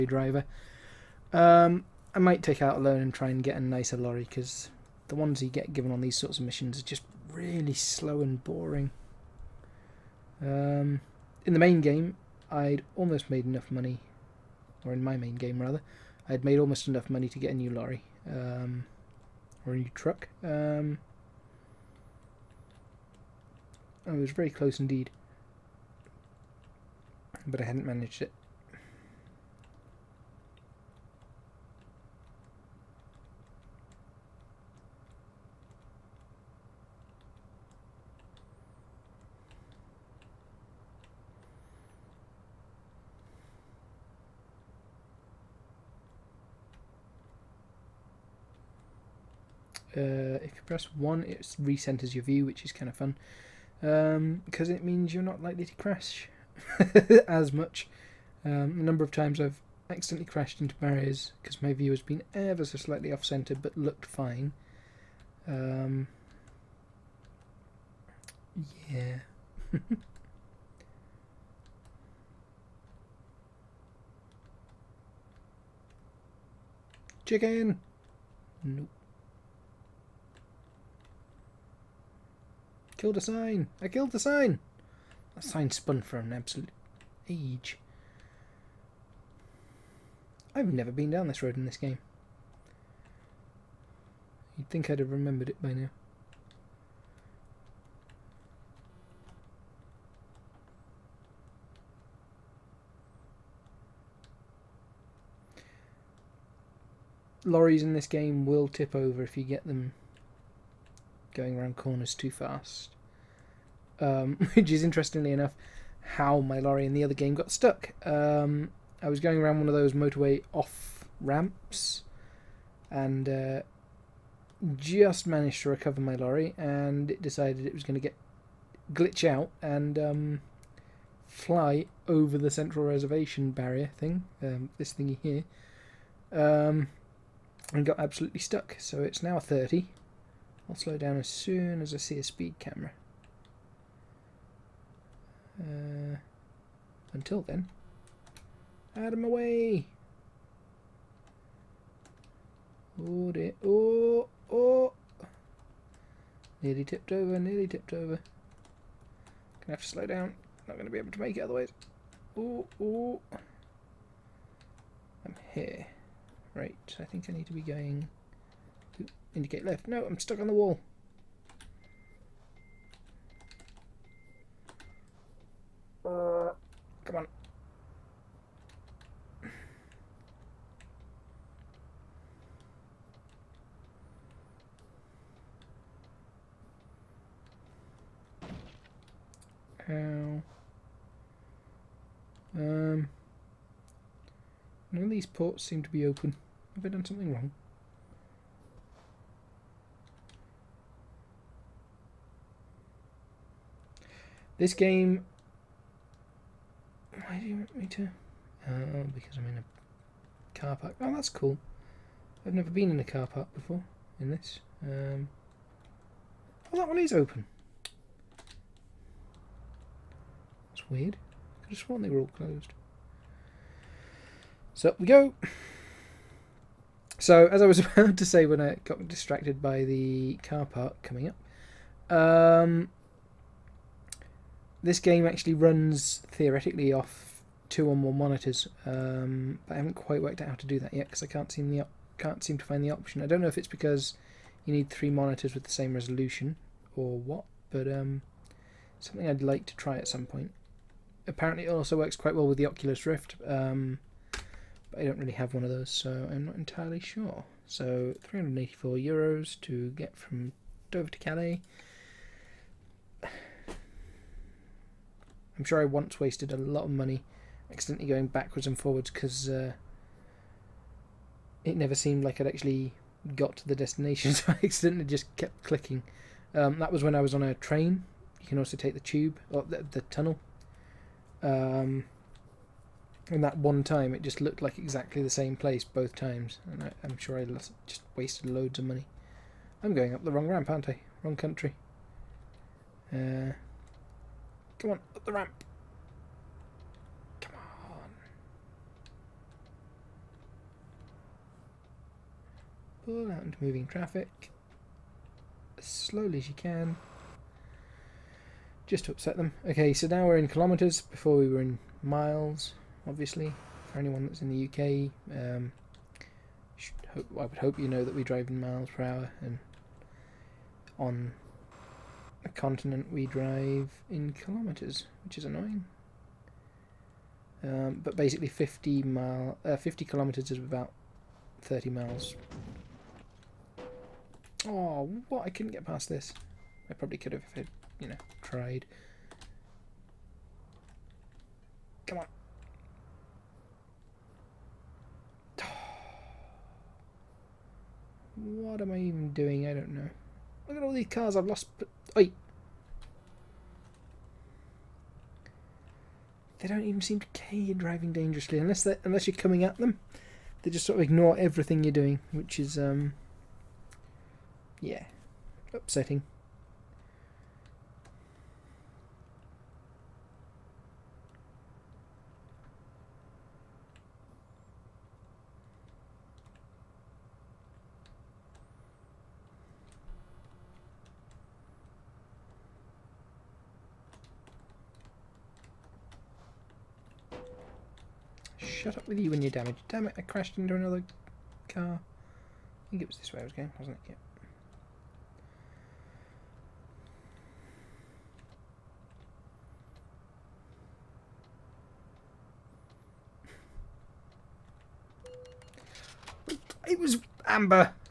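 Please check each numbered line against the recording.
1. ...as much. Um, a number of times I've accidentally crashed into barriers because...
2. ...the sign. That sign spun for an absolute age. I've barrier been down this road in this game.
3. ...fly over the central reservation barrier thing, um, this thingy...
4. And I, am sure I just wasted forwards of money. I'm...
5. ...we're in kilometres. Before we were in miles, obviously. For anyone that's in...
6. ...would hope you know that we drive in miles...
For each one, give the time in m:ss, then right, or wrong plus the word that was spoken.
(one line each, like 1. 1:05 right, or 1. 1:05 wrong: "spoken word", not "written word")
1. 0:57 right
2. 1:24 wrong: "never", not "barrier"
3. 2:11 right
4. 4:46 wrong: "loads", not "forwards"
5. 5:10 right
6. 5:17 right.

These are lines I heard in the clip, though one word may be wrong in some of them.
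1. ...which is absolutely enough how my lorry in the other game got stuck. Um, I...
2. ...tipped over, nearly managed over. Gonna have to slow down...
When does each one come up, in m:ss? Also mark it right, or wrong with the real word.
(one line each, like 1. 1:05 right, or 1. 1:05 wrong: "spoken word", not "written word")
1. 1:54 wrong: "interestingly", not "absolutely"
2. 2:36 wrong: "tipped", not "managed".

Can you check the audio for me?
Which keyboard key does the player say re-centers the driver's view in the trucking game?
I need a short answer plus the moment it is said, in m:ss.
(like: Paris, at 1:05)
1, at 0:50.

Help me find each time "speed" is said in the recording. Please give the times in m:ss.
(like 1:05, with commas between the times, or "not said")
2:22.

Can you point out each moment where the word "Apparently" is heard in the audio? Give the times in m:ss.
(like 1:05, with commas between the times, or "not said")
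4:11.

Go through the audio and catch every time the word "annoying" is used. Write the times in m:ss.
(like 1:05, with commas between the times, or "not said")
5:25.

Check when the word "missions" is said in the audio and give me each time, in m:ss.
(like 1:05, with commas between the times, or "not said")
0:06.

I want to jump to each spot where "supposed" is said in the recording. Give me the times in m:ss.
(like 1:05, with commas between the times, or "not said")
not said.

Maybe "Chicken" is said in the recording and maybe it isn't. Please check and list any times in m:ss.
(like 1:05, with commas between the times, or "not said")
1:17.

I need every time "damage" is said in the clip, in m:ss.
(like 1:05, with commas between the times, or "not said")
6:29.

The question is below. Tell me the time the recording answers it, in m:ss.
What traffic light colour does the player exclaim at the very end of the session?
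6:47.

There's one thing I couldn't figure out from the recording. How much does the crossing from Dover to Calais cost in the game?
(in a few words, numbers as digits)
384 euros.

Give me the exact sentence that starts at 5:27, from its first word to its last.
Um, but basically 50 mile, uh, 50 kilometres is about 30 miles.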